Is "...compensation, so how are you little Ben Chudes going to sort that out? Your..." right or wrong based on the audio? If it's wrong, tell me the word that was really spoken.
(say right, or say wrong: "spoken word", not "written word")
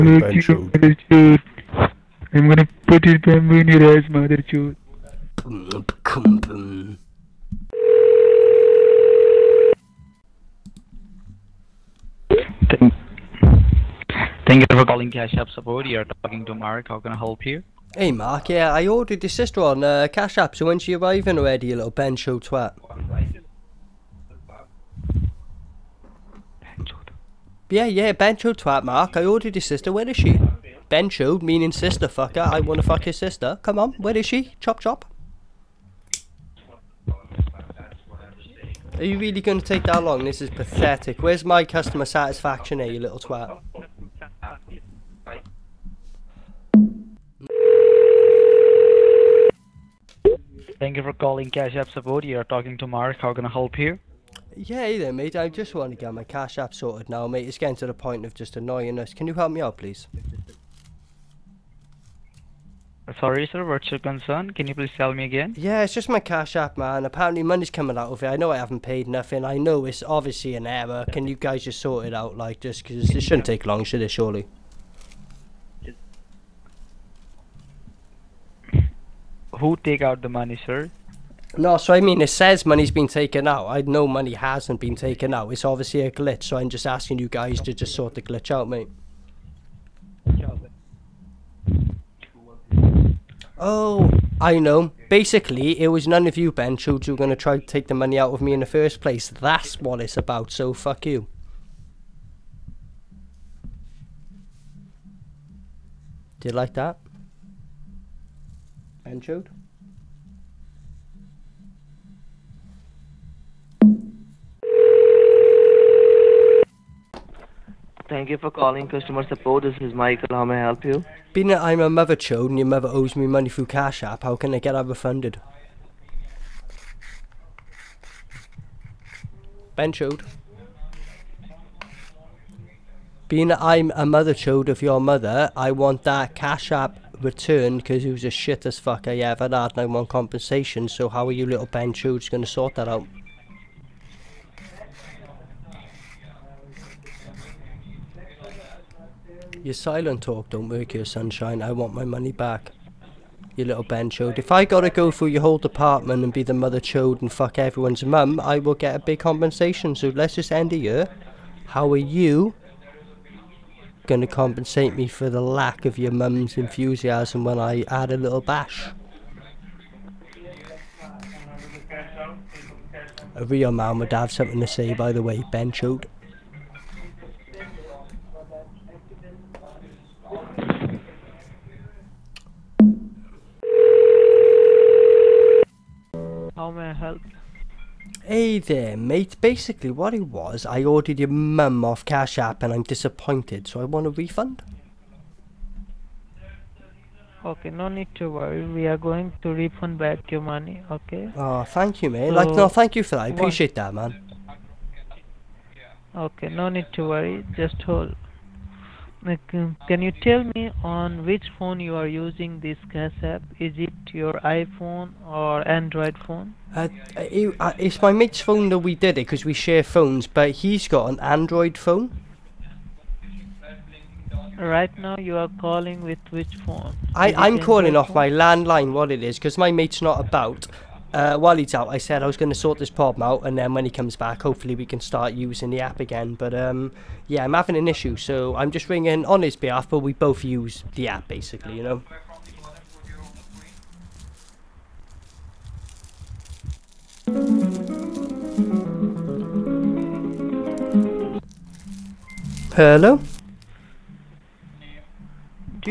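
right.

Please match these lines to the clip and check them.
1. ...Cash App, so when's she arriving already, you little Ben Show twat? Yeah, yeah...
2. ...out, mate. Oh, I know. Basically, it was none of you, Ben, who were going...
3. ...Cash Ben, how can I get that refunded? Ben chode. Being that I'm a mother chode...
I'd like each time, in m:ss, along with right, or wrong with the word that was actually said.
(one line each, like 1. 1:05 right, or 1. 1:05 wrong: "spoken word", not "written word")
1. 0:20 right
2. 1:28 right
3. 2:03 wrong: "App", not "Ben".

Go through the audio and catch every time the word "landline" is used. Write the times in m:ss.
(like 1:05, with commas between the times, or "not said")
3:48.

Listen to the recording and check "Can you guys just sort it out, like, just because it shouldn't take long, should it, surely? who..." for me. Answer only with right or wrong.
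right.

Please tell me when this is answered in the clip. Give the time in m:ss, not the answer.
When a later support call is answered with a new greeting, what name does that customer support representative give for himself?
1:59.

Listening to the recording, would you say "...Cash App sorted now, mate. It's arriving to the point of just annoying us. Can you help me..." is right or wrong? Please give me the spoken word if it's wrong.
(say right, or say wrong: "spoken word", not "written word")
wrong: "getting", not "arriving".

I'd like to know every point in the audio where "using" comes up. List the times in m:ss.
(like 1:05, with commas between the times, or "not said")
3:32, 3:55.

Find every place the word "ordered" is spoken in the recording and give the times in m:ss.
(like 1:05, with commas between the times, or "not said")
0:18, 0:29, 3:10.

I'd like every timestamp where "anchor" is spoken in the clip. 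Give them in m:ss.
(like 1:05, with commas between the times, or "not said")
1:49.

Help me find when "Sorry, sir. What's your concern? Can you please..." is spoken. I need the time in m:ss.
1:03.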